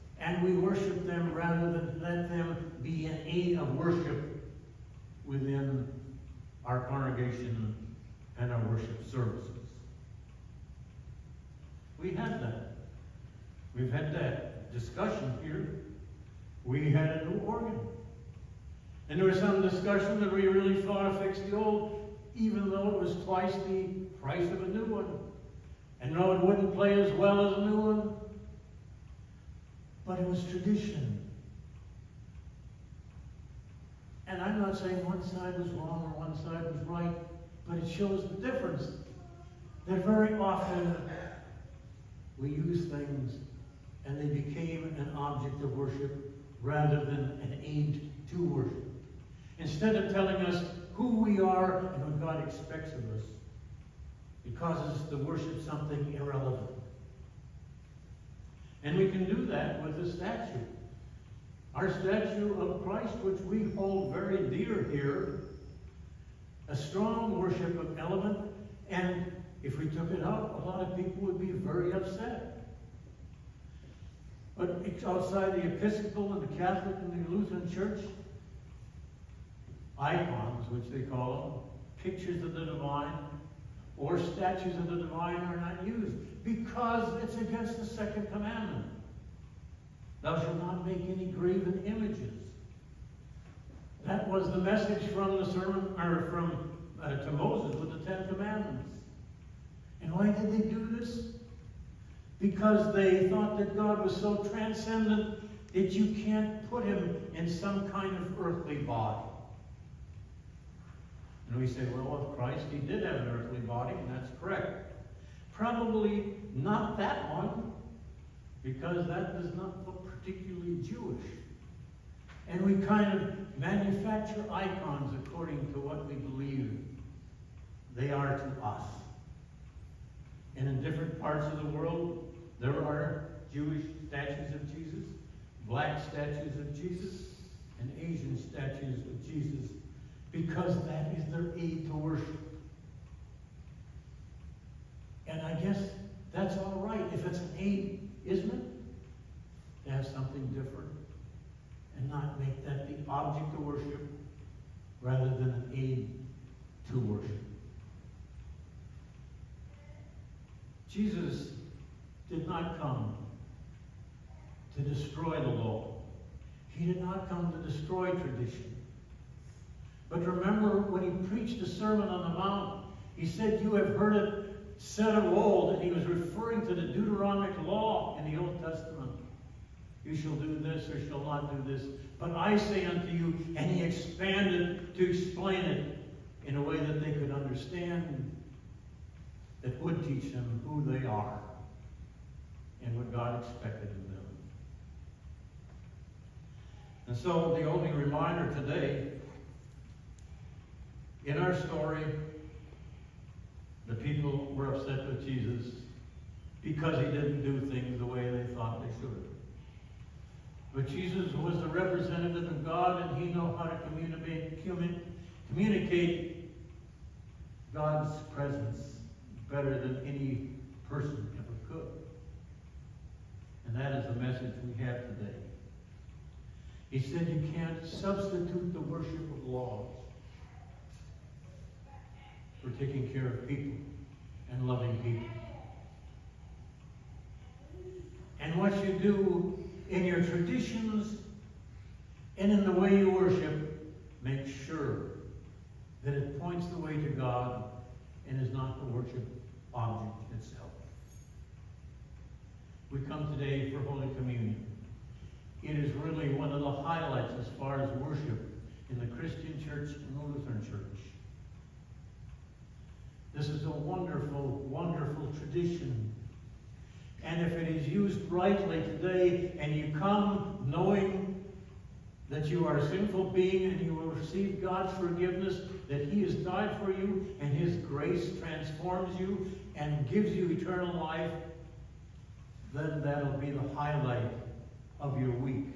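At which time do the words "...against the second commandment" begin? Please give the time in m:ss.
1:27.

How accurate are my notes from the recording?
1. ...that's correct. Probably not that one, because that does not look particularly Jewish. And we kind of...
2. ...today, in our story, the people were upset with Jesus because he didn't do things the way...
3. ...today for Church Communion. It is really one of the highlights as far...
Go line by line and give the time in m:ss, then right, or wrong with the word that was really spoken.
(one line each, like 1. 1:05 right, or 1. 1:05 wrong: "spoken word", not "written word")
1. 1:54 right
2. 3:18 right
3. 4:13 wrong: "Holy", not "Church".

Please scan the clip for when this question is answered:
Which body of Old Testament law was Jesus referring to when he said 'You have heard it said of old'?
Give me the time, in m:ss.
2:56.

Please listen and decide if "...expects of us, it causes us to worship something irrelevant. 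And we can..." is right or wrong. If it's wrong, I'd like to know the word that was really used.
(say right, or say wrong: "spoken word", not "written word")
right.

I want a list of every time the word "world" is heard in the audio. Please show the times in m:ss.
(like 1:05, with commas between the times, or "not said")
2:11.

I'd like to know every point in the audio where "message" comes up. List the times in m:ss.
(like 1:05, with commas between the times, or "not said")
1:34, 3:44.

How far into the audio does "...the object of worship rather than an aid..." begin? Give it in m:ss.
2:32.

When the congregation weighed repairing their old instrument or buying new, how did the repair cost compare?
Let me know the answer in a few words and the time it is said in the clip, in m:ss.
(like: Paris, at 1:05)
twice the price, at 0:23.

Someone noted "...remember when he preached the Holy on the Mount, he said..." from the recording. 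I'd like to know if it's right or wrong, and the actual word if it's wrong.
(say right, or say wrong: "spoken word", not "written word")
wrong: "Sermon", not "Holy".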